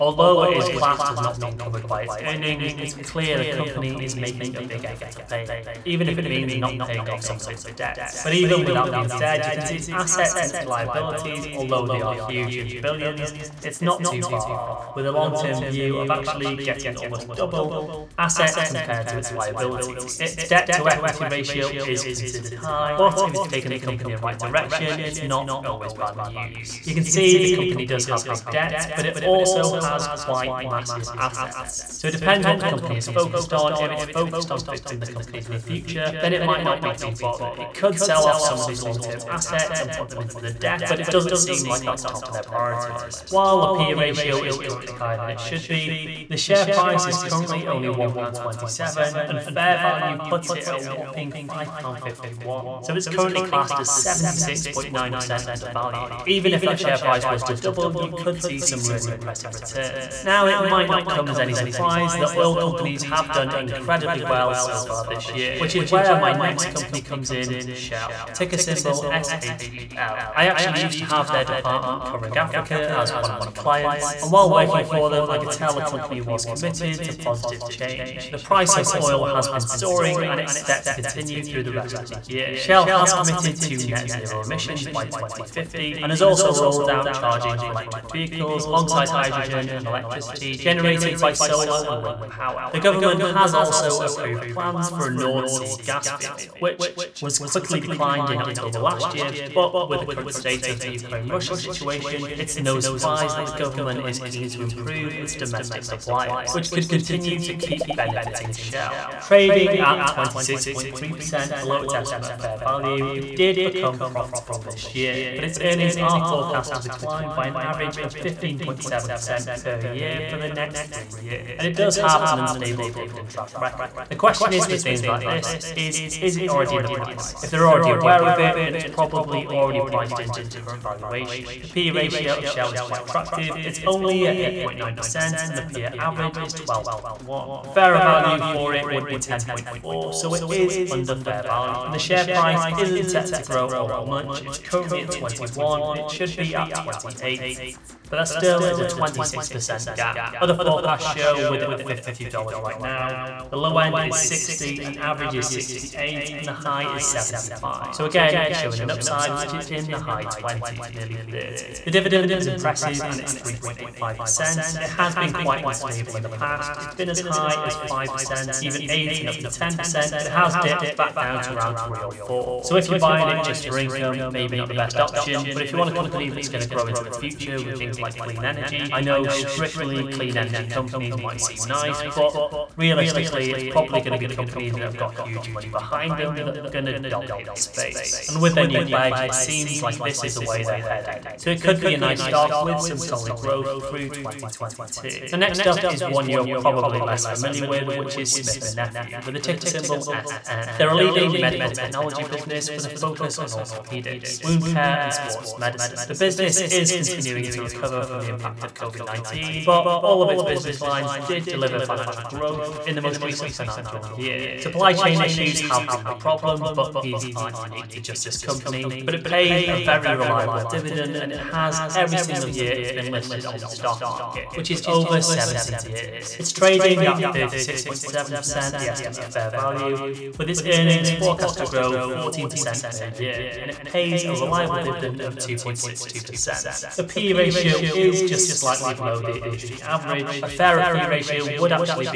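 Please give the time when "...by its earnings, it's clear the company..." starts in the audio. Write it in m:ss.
0:01.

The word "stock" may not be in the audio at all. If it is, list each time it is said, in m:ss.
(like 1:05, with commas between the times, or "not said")
3:12, 3:43.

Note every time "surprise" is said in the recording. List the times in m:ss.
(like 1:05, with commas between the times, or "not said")
1:01, 1:42.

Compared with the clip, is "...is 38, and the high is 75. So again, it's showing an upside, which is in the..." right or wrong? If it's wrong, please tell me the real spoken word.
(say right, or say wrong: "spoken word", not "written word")
wrong: "68", not "38".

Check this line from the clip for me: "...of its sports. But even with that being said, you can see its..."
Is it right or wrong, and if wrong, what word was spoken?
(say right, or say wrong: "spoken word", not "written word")
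wrong: "debts", not "sports".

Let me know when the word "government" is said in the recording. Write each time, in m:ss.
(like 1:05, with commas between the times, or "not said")
1:32, 1:43.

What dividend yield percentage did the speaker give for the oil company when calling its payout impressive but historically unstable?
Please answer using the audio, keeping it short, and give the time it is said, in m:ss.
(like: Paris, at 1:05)
3.85%, at 2:43.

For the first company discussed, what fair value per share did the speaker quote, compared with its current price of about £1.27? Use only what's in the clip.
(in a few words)
£5.51.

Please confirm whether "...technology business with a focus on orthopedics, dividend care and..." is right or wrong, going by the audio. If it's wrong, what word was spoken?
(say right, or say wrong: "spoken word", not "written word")
wrong: "wound", not "dividend".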